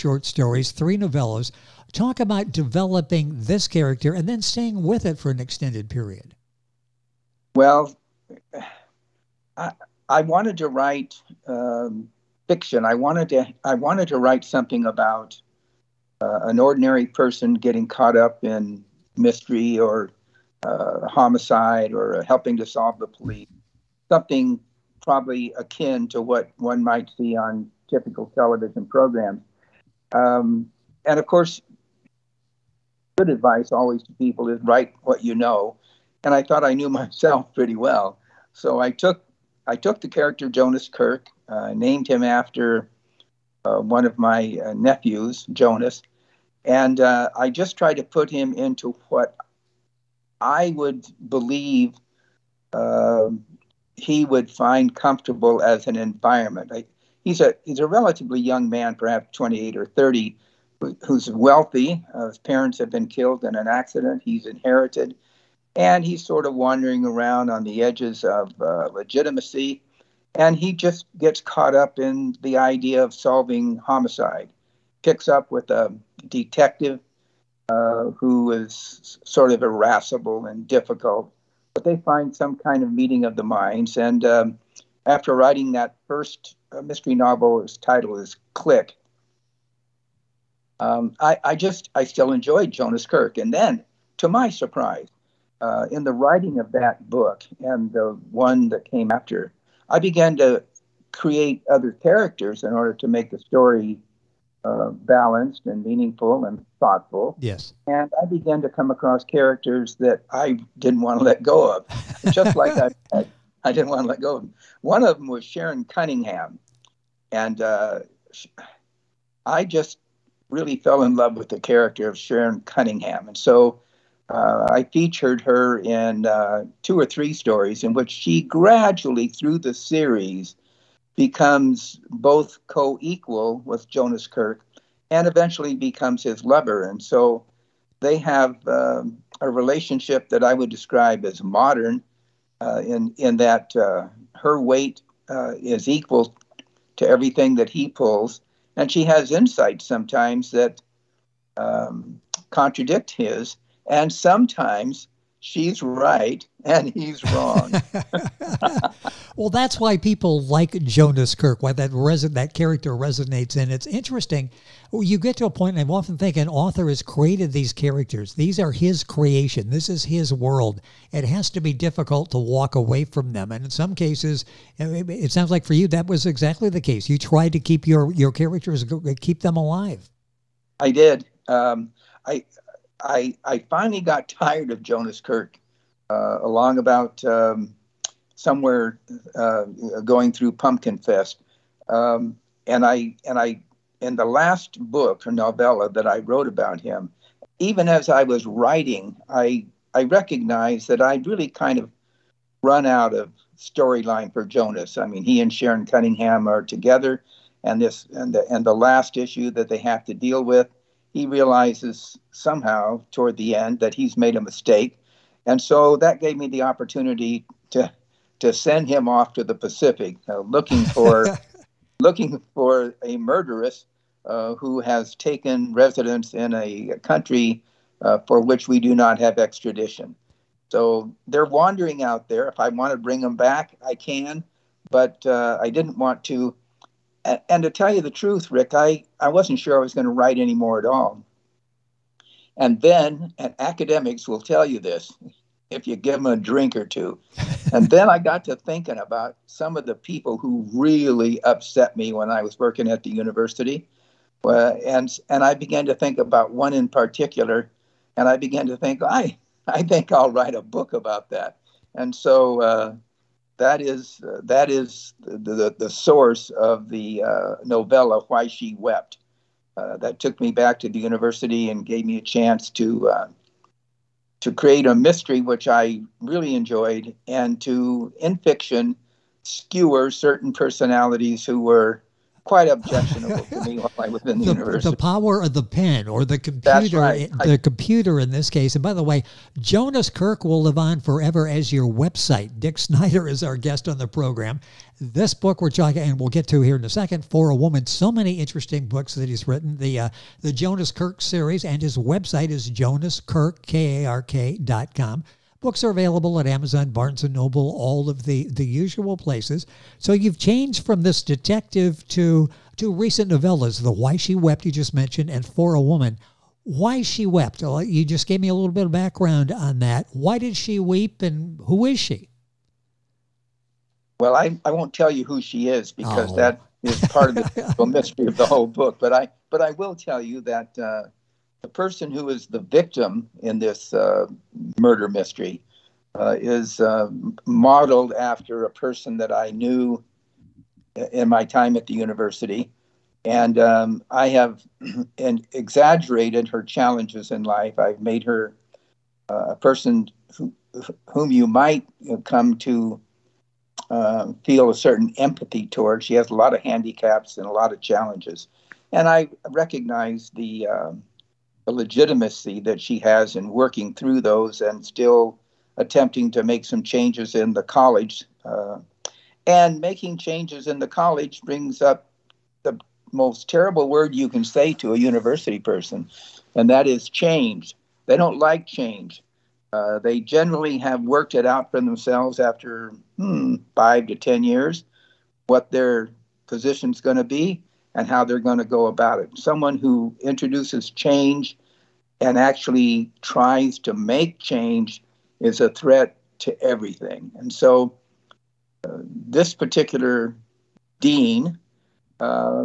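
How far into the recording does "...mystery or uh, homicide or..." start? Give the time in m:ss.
0:19.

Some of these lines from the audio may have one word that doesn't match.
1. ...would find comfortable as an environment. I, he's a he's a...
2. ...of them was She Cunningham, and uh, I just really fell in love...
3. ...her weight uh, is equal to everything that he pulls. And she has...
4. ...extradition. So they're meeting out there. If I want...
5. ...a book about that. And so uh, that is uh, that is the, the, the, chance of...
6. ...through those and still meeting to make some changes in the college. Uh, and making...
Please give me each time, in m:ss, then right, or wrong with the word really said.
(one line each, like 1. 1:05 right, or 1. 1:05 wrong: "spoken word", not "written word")
1. 0:54 right
2. 1:55 wrong: "Sharon", not "She"
3. 2:24 right
4. 3:49 wrong: "wandering", not "meeting"
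5. 4:20 wrong: "source", not "chance"
6. 6:03 wrong: "attempting", not "meeting".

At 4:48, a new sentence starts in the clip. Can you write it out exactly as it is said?
And by the way, Jonas Kirk will live on forever as your website.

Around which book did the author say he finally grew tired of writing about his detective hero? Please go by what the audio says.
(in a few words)
Pumpkin Fest.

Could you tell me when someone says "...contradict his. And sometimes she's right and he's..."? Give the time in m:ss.
2:32.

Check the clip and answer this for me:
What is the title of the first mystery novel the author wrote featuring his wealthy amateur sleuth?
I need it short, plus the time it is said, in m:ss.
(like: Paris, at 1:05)
Click, at 1:28.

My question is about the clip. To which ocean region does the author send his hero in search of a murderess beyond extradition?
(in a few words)
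The Pacific.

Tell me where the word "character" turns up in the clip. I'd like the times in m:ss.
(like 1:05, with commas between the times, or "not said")
0:03, 0:40, 1:41, 1:49, 2:01, 2:42, 2:47, 2:58.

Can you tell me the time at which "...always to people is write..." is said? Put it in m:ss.
0:33.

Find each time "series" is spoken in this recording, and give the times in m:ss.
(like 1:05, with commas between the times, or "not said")
2:09, 5:01.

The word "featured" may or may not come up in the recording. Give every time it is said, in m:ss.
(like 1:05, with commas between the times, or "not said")
2:04.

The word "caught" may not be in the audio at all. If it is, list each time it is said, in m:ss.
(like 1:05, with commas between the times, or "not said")
0:17, 1:11.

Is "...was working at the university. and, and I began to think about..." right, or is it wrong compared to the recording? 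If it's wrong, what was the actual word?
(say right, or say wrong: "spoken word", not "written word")
right.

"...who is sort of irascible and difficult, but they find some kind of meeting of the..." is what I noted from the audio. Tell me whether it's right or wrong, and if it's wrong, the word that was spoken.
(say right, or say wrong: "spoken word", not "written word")
right.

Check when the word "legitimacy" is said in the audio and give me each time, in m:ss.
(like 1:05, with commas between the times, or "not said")
1:08, 6:01.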